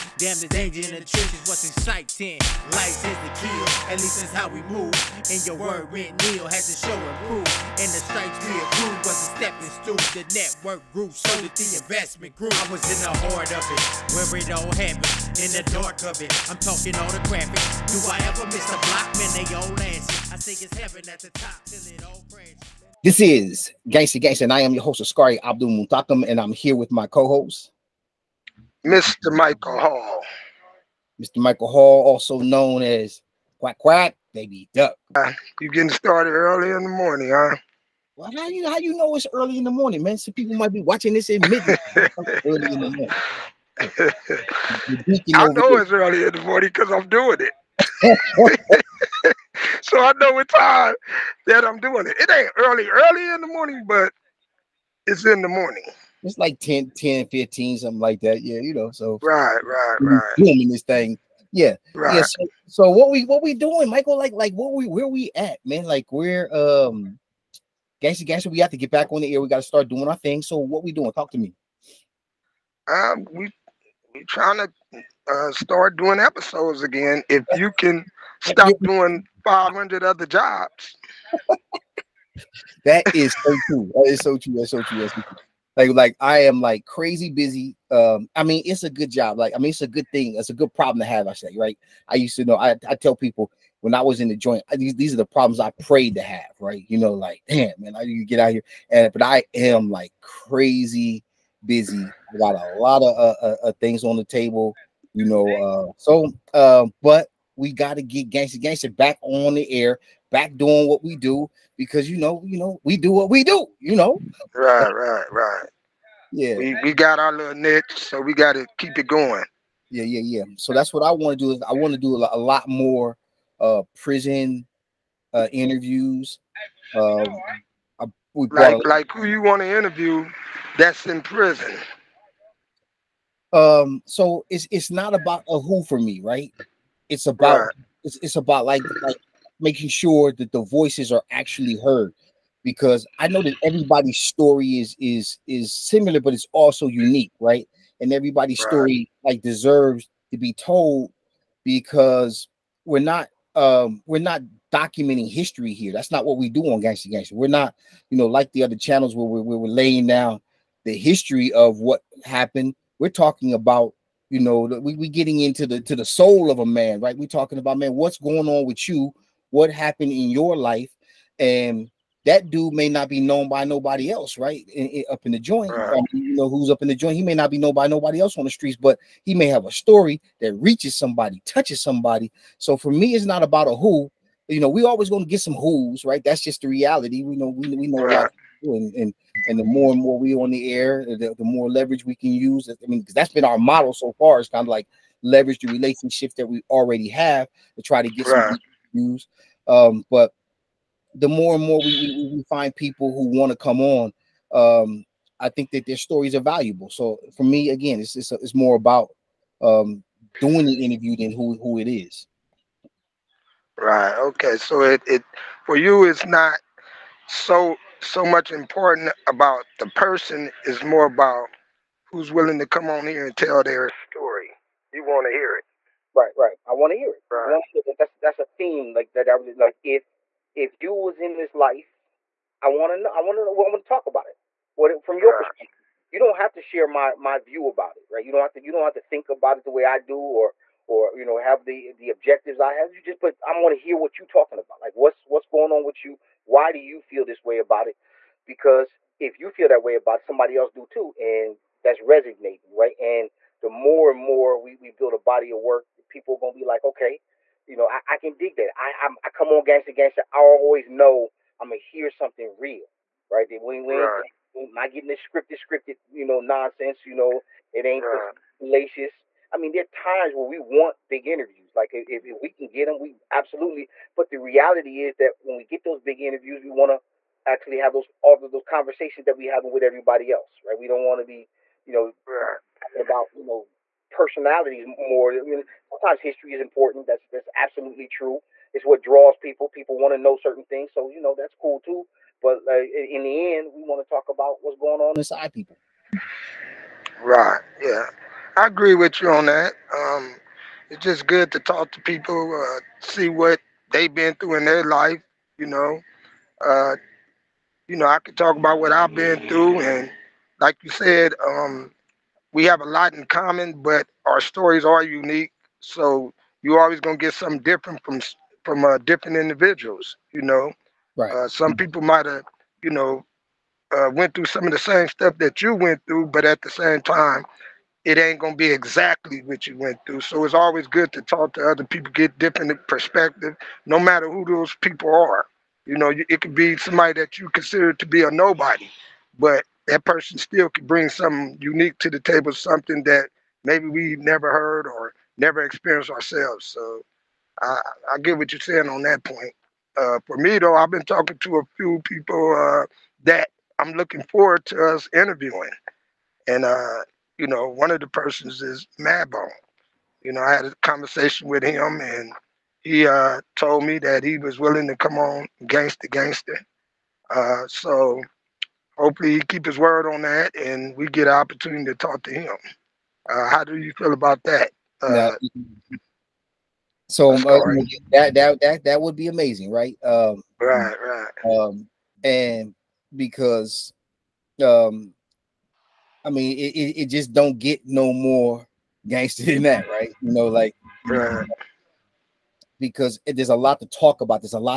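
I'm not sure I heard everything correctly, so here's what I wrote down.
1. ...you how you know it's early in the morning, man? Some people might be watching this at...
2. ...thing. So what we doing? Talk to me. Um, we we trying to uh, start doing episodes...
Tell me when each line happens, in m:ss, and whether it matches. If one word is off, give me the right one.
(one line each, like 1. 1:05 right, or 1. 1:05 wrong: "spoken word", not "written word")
1. 0:38 right
2. 1:10 right.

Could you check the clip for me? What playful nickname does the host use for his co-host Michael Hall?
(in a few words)
Quack Quack Baby Duck.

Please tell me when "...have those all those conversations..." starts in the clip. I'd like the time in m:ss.
4:37.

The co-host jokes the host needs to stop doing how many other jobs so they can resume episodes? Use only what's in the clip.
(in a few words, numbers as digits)
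500.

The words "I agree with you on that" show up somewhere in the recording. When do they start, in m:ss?
4:58.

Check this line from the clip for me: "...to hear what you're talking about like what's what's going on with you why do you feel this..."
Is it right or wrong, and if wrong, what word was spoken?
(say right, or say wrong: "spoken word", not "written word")
right.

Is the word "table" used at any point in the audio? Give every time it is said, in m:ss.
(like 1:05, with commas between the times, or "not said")
1:44, 5:42.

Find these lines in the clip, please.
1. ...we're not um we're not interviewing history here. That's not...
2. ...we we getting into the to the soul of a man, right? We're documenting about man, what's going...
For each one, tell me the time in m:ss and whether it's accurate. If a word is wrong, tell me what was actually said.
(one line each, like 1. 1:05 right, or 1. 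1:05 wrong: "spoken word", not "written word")
1. 2:32 wrong: "documenting", not "interviewing"
2. 2:44 wrong: "talking", not "documenting".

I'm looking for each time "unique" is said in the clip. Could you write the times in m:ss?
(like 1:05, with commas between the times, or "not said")
2:26, 5:15, 5:41.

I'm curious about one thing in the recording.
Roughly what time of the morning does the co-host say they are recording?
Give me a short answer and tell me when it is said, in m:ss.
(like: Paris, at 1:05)
10:15, at 0:56.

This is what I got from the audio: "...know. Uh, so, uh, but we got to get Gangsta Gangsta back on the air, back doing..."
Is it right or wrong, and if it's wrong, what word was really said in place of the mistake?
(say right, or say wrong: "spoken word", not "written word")
right.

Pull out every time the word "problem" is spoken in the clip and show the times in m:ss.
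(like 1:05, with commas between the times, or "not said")
1:30, 1:35.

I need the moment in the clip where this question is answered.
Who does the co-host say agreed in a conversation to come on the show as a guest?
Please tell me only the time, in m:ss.
5:58.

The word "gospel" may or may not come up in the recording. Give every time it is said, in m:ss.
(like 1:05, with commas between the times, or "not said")
not said.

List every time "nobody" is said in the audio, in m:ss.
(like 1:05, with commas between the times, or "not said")
2:53, 2:57, 5:38.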